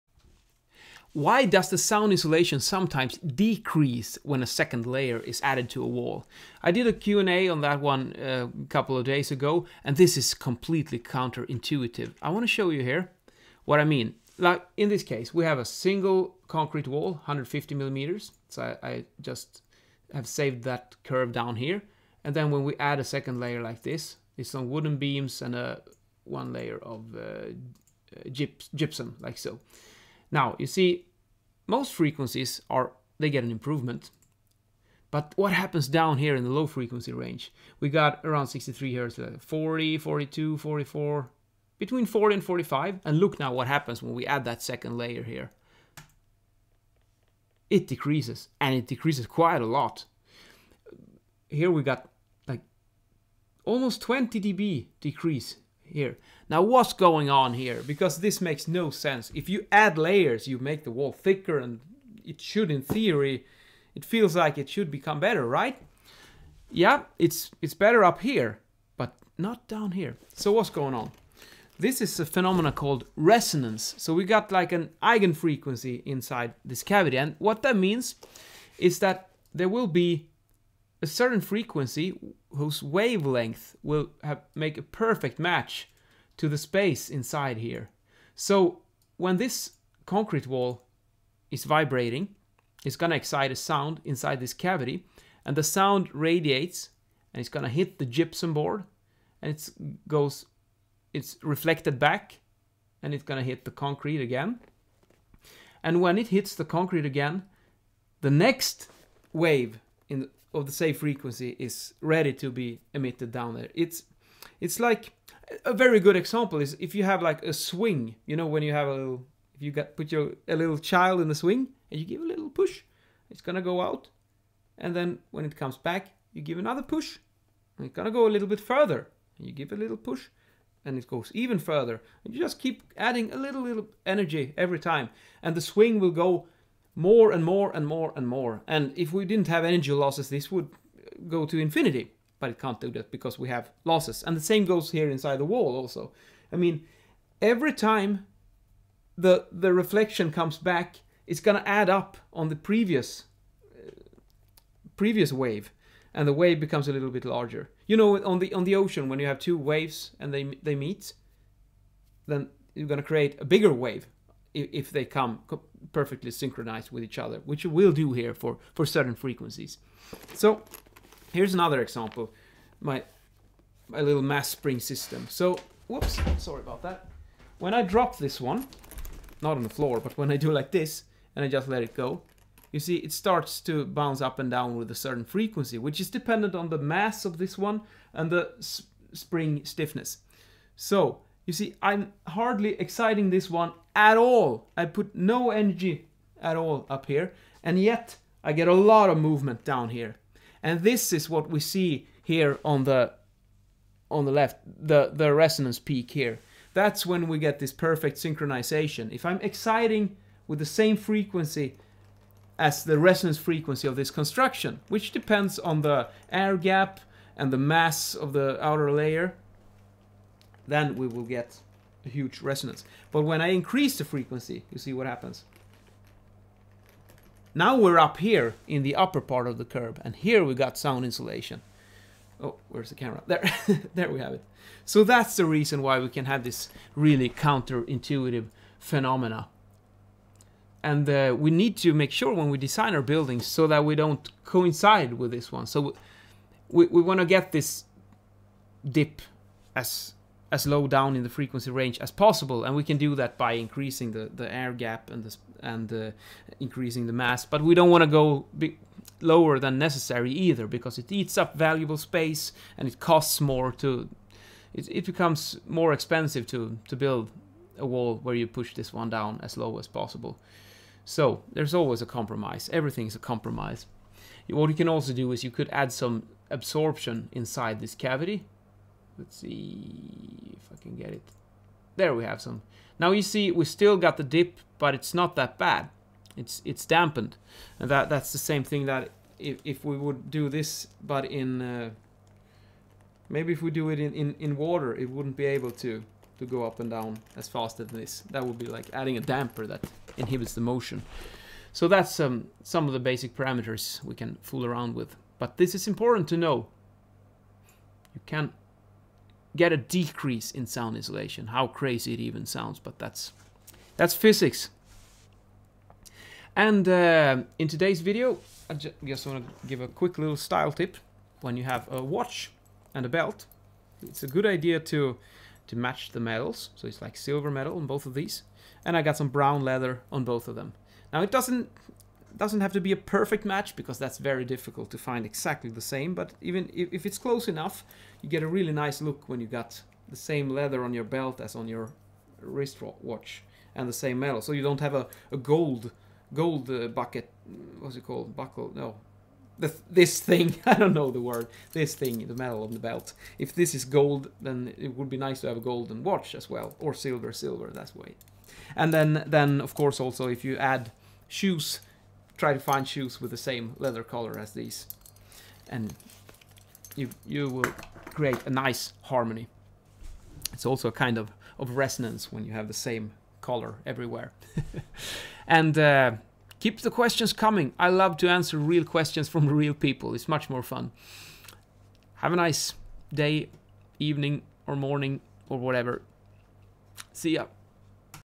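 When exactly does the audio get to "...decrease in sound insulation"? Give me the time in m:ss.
5:09.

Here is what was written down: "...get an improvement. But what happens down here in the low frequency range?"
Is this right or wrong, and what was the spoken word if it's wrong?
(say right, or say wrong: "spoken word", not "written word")
right.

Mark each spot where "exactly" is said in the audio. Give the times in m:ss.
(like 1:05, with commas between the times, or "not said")
5:35.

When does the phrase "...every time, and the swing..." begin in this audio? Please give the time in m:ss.
2:14.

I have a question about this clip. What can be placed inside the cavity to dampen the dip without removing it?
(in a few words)
absorption.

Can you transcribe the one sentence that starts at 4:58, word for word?
That would be like adding a damper that inhibits the motion.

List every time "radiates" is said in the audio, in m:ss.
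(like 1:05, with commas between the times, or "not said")
1:36.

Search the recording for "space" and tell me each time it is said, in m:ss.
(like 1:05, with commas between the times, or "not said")
1:26, 4:21.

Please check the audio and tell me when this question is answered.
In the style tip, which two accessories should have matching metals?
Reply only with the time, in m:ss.
5:21.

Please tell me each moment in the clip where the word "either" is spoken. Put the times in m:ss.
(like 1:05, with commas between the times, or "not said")
4:20.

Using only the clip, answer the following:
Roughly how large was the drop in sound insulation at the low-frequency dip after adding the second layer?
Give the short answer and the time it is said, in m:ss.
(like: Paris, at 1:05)
almost 20 dB, at 0:53.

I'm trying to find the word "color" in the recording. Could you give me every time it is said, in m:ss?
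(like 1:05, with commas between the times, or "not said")
6:04, 6:13.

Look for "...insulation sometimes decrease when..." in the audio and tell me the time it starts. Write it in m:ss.
0:02.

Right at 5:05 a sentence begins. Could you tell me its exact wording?
But this is important to know.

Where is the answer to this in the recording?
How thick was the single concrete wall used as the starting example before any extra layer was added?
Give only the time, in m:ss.
0:17.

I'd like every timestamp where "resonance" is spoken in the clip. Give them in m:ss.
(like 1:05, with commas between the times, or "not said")
1:13, 3:25, 3:32, 3:42, 6:11.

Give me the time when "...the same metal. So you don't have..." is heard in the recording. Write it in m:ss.
5:43.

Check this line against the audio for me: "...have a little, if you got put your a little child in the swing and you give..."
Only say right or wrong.
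right.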